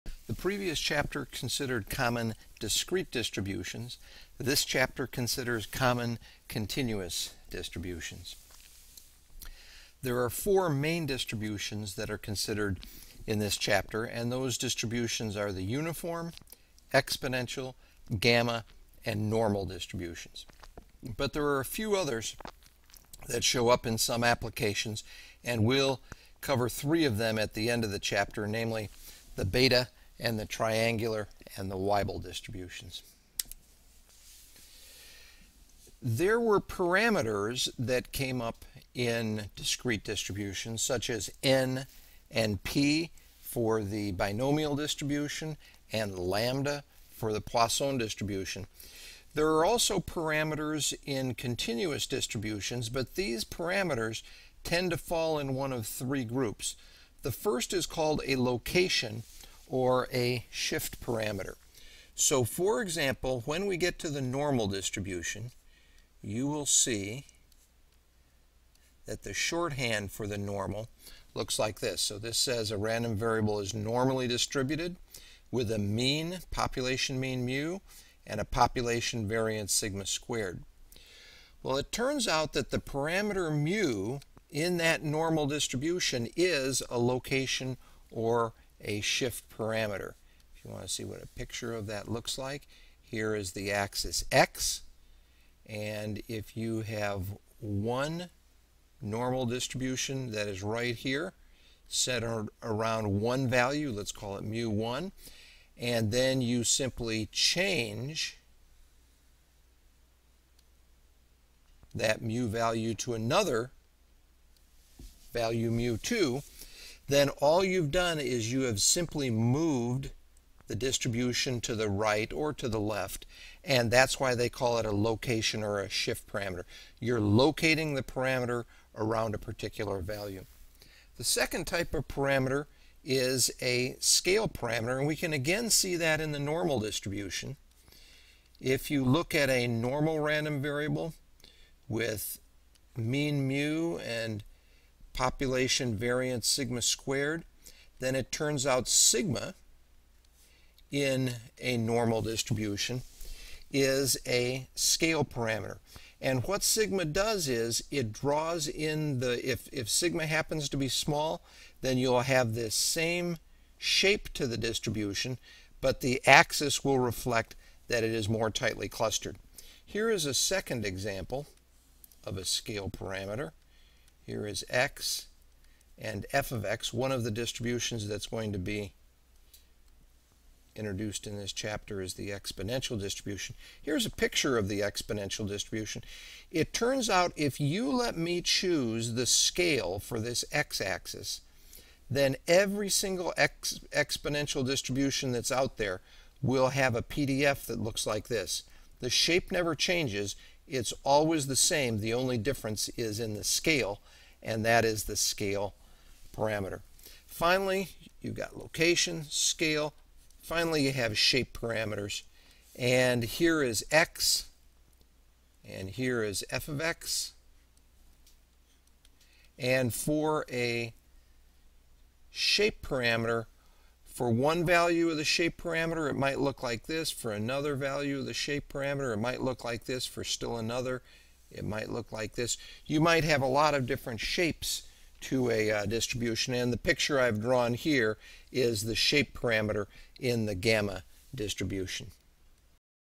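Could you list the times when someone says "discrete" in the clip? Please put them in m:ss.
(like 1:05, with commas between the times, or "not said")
0:02, 0:39.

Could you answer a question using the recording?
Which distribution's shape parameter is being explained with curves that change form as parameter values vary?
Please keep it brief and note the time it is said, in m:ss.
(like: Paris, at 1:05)
gamma distribution, at 4:00.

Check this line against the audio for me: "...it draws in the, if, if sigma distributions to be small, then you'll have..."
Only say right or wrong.
wrong.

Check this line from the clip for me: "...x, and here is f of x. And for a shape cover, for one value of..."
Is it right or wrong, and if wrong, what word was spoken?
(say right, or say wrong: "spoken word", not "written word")
wrong: "parameter", not "cover".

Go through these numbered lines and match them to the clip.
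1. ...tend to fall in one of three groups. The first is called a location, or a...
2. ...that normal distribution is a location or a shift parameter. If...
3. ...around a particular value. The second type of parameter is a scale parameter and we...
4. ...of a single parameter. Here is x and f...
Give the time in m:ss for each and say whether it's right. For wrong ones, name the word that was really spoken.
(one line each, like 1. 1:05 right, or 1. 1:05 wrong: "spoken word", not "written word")
1. 0:54 right
2. 1:24 right
3. 2:08 right
4. 2:52 wrong: "scale", not "single".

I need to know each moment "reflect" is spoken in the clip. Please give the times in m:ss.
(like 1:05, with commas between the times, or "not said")
2:46.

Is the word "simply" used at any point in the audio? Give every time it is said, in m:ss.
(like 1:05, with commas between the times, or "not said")
1:46, 1:58.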